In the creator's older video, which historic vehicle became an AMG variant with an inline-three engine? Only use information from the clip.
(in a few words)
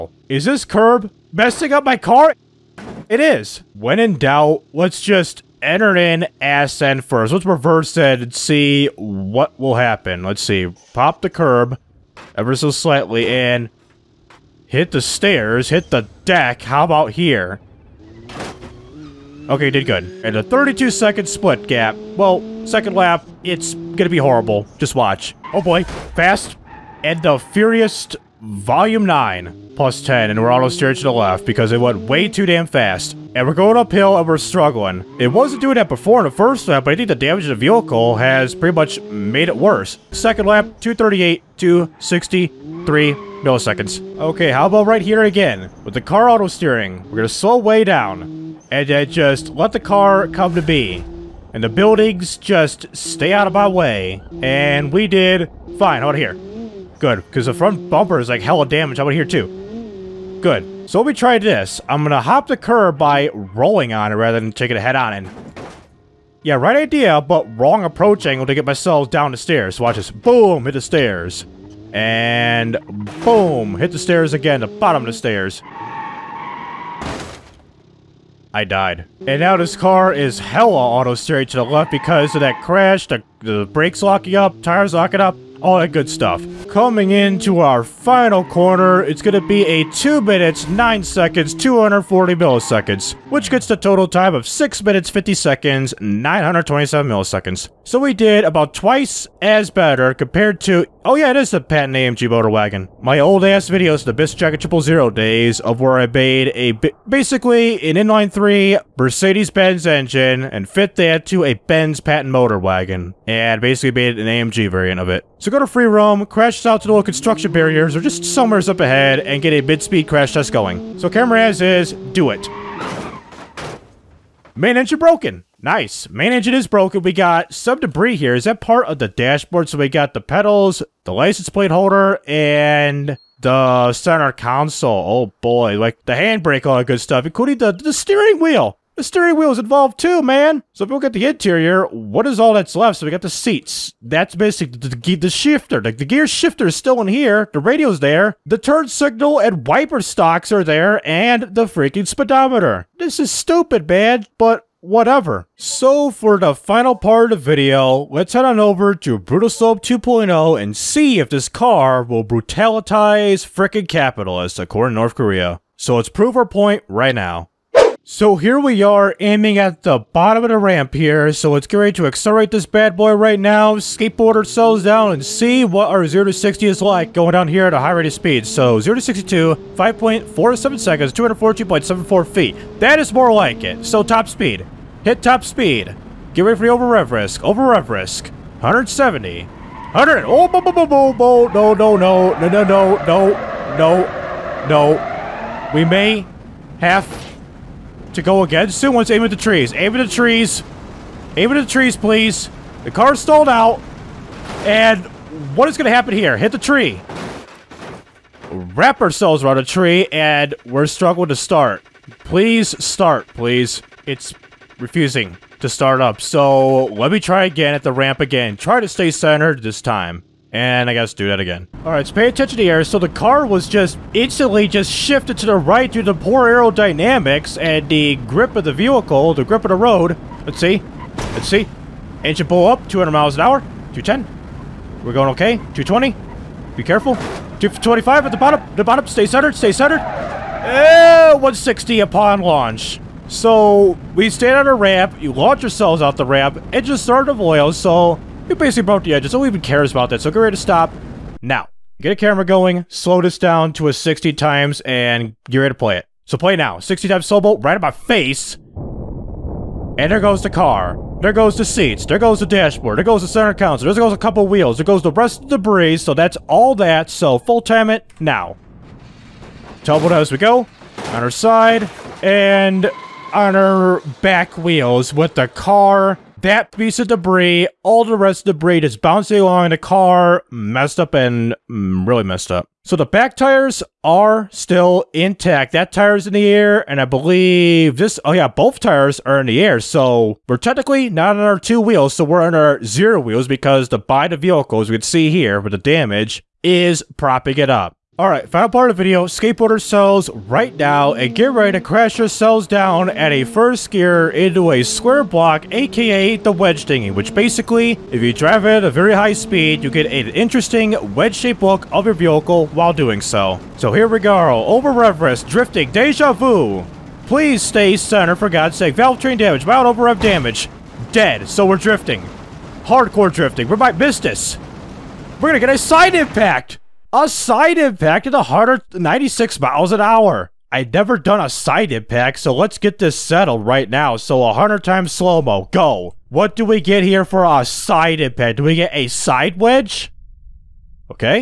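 Benz patent motor wagon.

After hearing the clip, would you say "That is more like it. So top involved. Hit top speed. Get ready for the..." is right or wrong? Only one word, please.
wrong.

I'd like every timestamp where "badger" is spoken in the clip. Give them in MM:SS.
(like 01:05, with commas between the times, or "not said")
not said.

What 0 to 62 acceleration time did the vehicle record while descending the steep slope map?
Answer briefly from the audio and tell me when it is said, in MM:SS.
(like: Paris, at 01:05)
5.47 seconds, at 02:59.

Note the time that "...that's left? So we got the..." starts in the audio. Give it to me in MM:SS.
02:22.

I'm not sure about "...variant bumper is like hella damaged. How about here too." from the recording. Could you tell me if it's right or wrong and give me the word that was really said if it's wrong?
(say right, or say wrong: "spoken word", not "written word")
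wrong: "front", not "variant".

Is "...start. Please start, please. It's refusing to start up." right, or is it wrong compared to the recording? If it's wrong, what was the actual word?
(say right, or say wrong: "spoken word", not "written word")
right.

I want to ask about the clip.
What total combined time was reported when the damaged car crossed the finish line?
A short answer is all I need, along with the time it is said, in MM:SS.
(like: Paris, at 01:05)
6 minutes, 50 seconds, 927 milliseconds, at 01:34.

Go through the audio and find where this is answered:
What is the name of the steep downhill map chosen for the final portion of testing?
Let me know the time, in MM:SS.
02:39.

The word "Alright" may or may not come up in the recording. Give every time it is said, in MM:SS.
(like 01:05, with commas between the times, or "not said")
03:41, 04:58.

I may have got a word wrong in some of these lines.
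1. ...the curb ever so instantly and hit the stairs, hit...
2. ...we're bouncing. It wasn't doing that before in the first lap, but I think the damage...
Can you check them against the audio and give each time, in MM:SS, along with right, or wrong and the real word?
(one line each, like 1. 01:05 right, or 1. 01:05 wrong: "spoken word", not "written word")
1. 00:11 wrong: "slightly", not "instantly"
2. 00:34 wrong: "struggling", not "bouncing".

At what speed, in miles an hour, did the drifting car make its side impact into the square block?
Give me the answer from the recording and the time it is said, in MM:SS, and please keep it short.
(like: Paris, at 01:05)
196, at 05:28.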